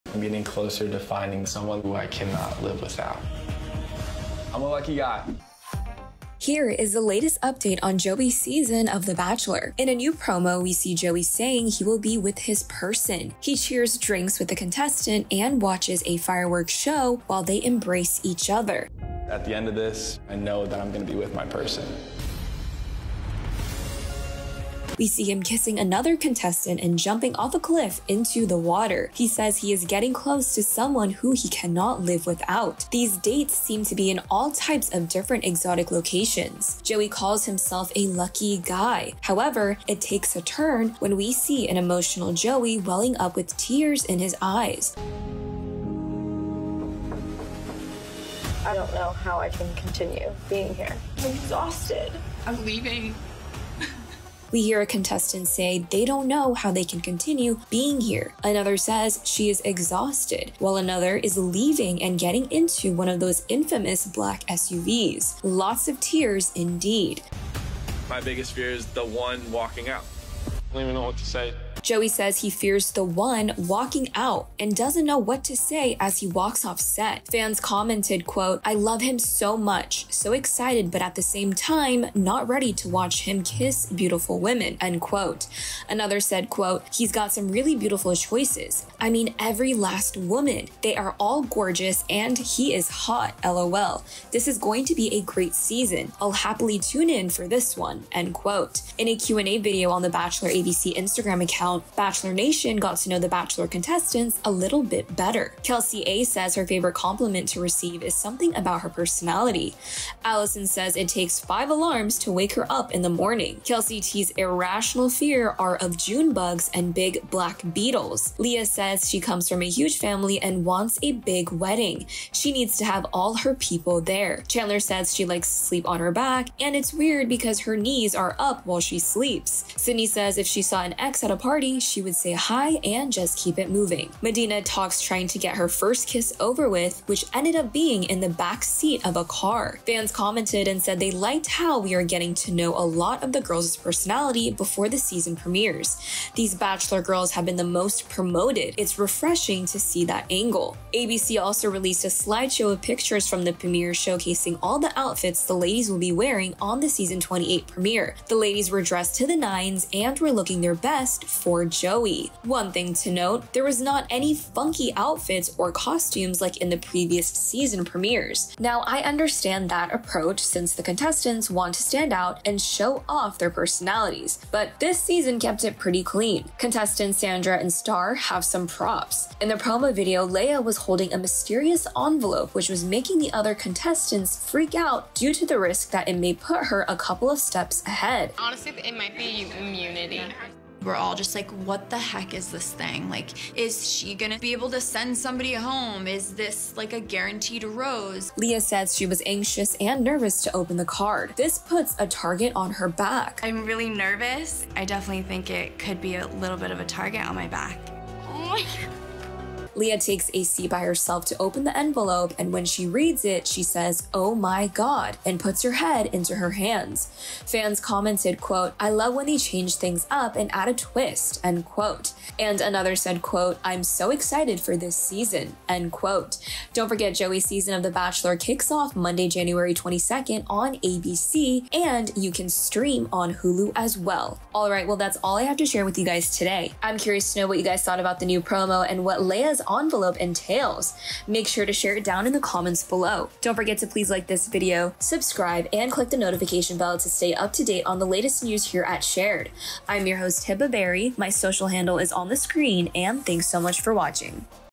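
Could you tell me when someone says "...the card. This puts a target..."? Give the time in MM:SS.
03:20.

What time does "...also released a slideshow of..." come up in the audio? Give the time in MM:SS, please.
02:31.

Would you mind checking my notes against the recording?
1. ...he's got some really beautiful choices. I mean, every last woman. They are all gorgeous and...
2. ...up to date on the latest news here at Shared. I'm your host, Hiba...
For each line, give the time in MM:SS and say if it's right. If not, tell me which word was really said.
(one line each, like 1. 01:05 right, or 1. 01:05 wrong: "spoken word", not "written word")
1. 01:26 right
2. 04:07 right.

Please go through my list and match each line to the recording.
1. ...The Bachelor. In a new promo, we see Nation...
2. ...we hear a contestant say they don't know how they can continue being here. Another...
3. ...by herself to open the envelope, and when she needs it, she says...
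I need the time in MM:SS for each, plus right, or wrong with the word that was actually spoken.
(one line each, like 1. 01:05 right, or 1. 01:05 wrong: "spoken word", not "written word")
1. 00:09 wrong: "Joey", not "Nation"
2. 00:54 right
3. 03:30 wrong: "reads", not "needs".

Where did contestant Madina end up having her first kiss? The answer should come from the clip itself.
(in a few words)
back seat of a car.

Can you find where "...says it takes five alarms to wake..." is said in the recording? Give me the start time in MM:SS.
01:50.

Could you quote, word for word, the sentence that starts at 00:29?
He says he is getting close to someone who he cannot live without.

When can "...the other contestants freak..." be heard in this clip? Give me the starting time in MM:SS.
03:03.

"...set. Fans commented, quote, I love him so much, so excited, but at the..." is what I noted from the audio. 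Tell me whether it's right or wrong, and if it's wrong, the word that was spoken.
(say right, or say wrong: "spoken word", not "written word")
right.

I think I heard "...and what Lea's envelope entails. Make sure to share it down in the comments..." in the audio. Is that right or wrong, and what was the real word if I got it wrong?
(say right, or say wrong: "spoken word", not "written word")
right.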